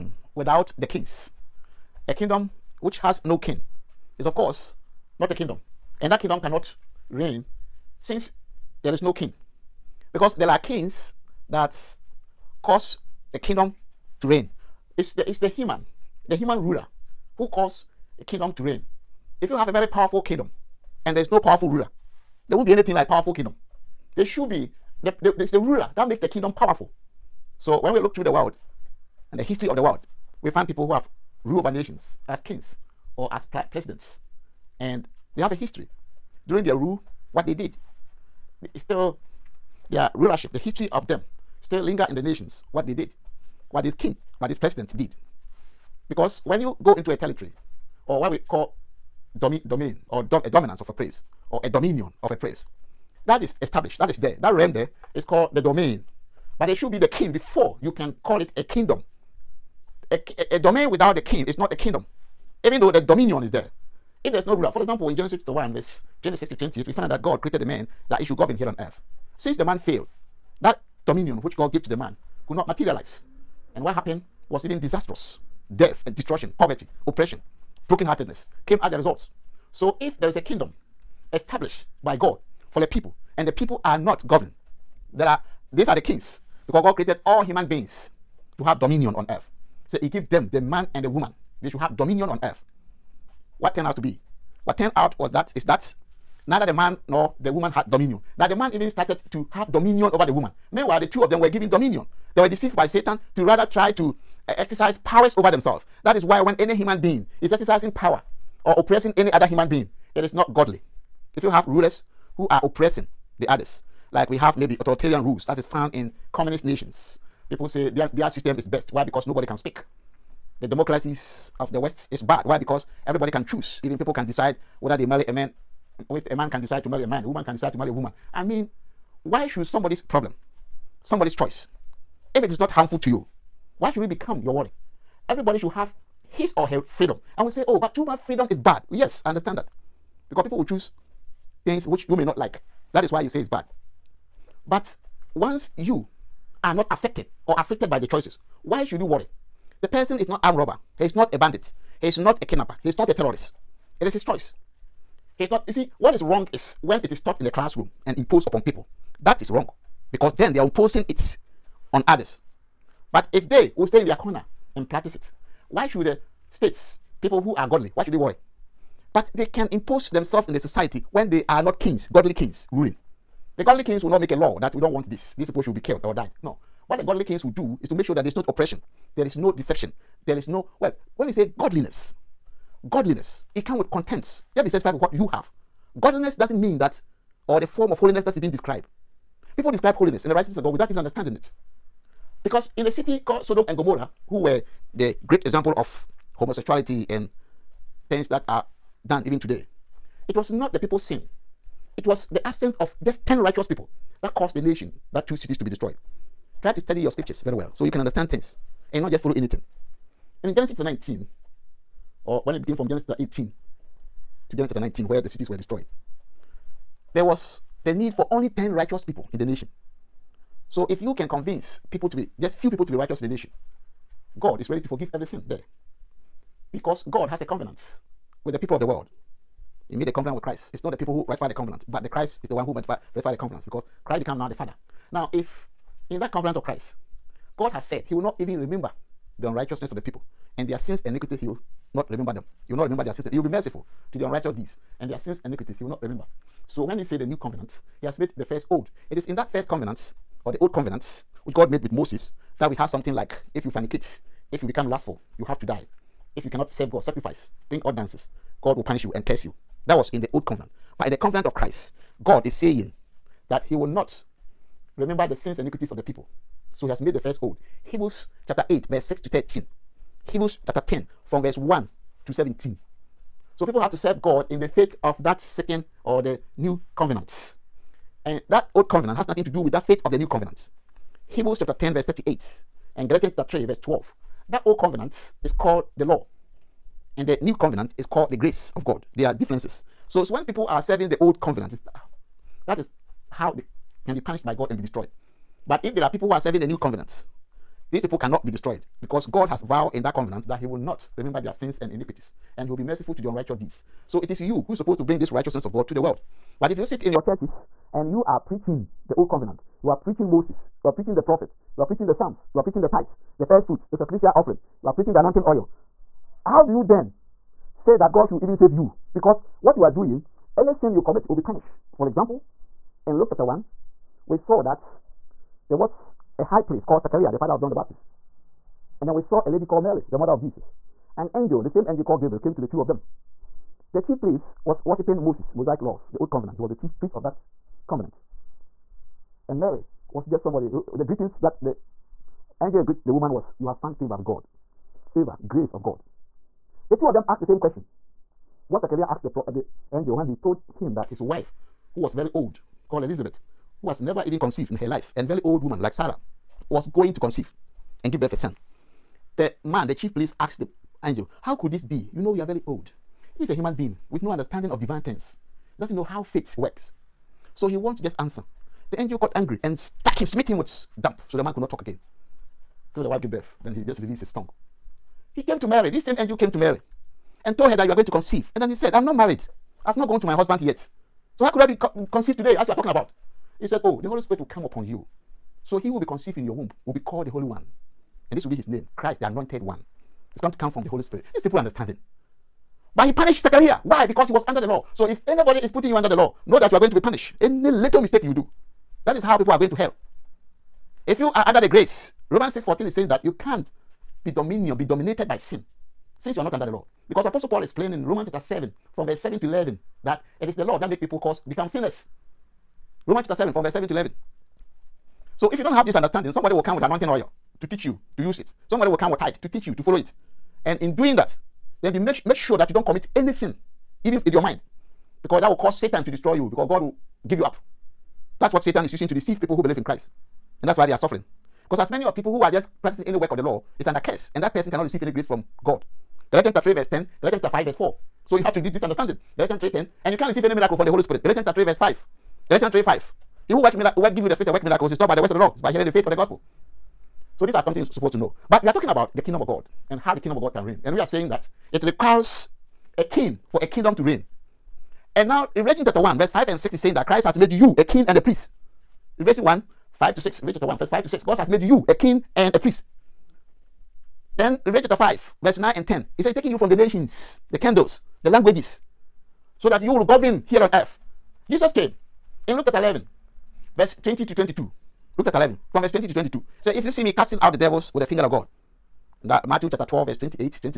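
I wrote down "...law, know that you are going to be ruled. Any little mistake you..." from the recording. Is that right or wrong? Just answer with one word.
wrong.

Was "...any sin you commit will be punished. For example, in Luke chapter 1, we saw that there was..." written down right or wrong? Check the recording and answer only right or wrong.
right.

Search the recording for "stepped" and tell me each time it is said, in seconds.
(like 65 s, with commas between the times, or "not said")
not said.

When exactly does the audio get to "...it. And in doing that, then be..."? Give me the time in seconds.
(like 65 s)
419 s.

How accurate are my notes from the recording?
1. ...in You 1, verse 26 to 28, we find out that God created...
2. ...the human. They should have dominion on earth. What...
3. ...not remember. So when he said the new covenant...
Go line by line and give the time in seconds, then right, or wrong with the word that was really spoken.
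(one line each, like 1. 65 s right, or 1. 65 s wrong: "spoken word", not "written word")
1. 65 s wrong: "Genesis", not "You"
2. 91 s wrong: "woman", not "human"
3. 245 s right.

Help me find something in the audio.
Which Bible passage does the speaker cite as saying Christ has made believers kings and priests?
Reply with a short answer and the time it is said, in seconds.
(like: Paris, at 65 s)
Revelation 1:5-6, at 455 s.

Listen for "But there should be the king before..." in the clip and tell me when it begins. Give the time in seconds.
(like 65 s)
56 s.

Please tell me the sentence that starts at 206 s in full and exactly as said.
Try to study your scriptures very well so you can understand things and not just follow anything.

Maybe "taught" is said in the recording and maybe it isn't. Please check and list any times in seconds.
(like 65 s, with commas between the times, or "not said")
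157 s, 444 s.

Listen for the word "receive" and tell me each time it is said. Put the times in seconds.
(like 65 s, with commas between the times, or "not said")
434 s, 440 s.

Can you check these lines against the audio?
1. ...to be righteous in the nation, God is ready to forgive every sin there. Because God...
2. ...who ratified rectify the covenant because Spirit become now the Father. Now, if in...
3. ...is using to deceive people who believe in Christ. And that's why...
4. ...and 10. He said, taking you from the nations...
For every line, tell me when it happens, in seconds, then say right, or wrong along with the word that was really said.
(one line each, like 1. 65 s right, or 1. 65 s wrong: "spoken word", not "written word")
1. 222 s right
2. 232 s wrong: "Christ", not "Spirit"
3. 428 s right
4. 465 s right.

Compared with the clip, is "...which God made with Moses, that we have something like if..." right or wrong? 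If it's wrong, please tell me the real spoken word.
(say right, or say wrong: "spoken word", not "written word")
right.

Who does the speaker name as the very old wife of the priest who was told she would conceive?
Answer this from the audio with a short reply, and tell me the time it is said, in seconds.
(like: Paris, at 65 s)
Elizabeth, at 353 s.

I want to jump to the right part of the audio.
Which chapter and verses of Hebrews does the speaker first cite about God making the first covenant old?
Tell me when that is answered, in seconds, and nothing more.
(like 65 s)
267 s.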